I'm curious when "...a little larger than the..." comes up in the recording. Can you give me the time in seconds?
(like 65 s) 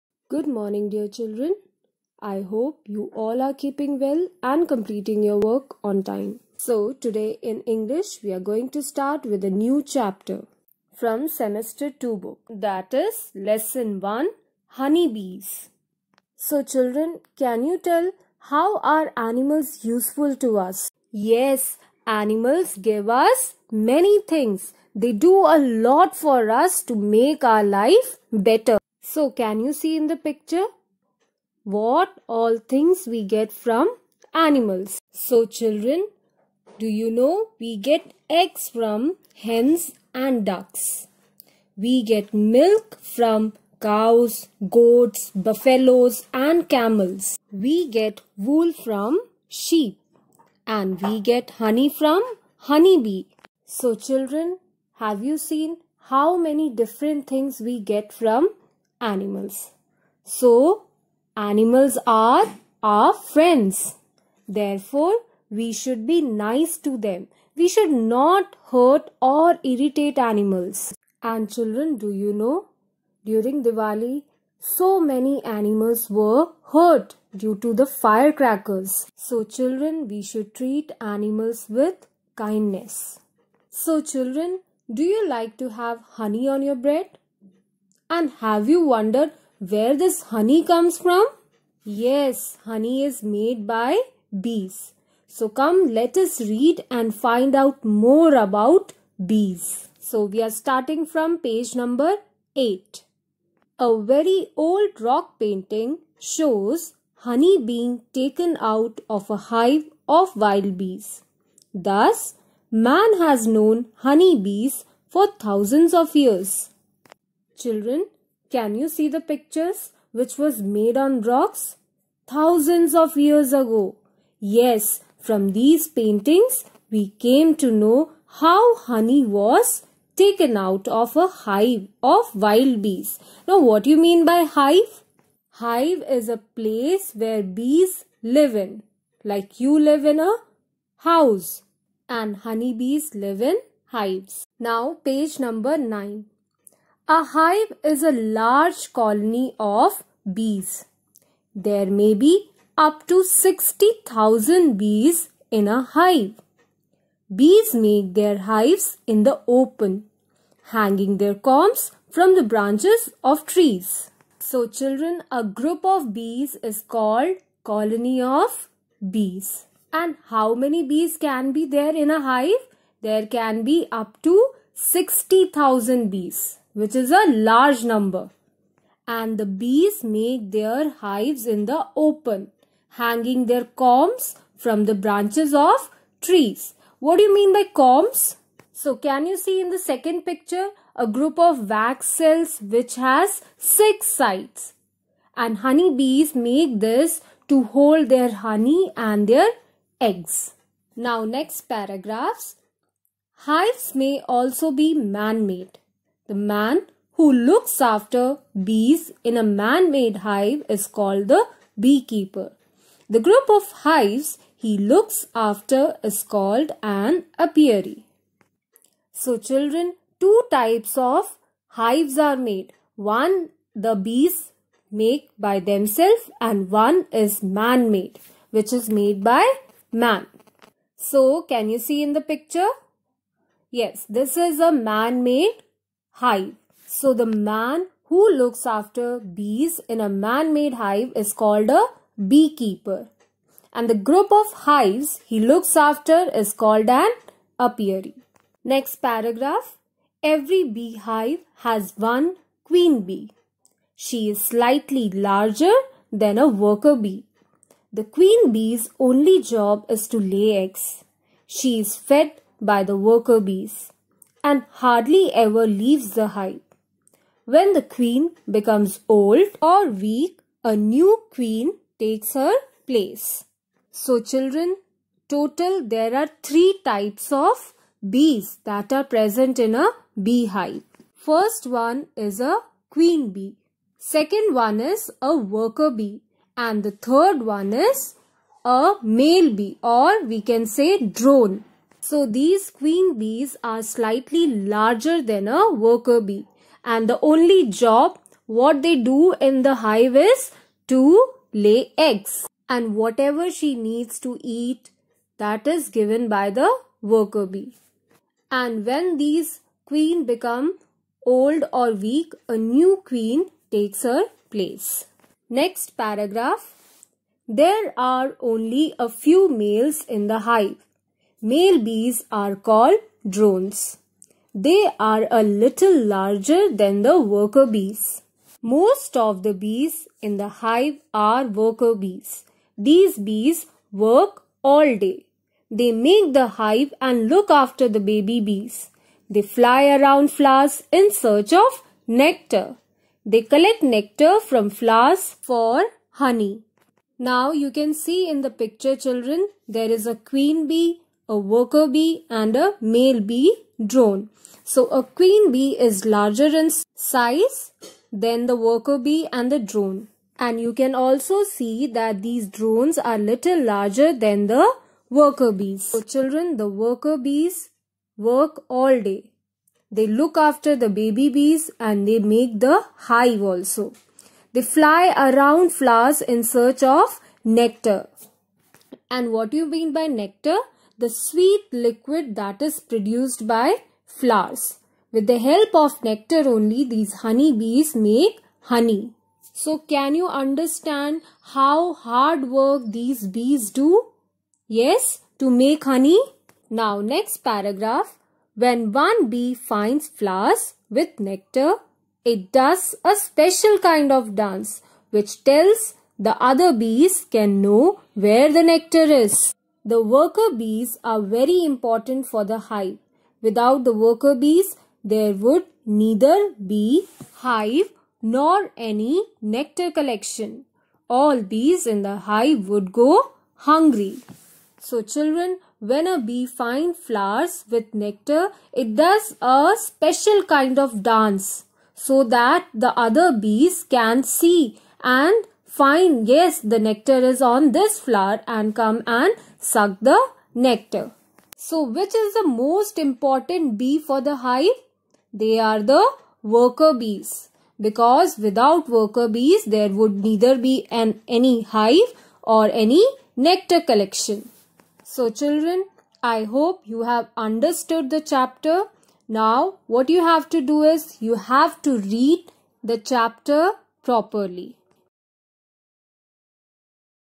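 325 s.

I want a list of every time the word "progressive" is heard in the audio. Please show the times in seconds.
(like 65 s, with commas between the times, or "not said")
not said.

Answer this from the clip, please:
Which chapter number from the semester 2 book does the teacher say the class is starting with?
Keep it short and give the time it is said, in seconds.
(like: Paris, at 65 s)
Lesson 1, at 13 s.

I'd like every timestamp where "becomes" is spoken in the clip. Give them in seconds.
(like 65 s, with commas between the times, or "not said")
268 s, 310 s.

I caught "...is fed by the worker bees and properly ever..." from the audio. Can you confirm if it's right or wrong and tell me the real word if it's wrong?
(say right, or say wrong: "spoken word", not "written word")
wrong: "hardly", not "properly".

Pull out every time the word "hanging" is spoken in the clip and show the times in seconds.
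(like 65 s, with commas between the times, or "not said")
160 s, 182 s.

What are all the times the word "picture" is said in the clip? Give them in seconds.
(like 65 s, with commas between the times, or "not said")
30 s, 119 s, 190 s, 232 s, 348 s.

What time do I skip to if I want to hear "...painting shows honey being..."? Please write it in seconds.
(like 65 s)
105 s.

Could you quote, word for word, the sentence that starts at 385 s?
With the help of nectar only, these honey bees make honey.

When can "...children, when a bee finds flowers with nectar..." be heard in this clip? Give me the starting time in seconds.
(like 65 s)
425 s.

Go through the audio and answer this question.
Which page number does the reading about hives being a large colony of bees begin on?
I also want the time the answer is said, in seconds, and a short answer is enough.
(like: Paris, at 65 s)
9, at 145 s.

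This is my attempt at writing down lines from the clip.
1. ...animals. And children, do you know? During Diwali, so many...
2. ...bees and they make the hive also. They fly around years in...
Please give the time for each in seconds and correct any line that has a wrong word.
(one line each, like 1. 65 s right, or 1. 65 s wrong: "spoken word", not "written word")
1. 70 s right
2. 371 s wrong: "flowers", not "years".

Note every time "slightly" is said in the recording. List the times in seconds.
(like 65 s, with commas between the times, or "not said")
254 s, 293 s.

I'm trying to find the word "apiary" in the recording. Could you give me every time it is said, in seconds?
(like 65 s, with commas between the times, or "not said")
217 s, 247 s.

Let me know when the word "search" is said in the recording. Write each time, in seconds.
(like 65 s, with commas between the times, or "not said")
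341 s, 376 s.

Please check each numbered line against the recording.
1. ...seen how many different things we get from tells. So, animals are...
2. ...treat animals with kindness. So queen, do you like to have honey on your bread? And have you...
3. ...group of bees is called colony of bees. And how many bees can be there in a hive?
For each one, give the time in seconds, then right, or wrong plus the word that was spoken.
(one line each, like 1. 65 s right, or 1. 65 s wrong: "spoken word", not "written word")
1. 55 s wrong: "animals", not "tells"
2. 80 s wrong: "children", not "queen"
3. 165 s right.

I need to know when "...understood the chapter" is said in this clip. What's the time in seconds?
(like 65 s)
457 s.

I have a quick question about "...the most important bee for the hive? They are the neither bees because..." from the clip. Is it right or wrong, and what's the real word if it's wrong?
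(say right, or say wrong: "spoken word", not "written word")
wrong: "worker", not "neither".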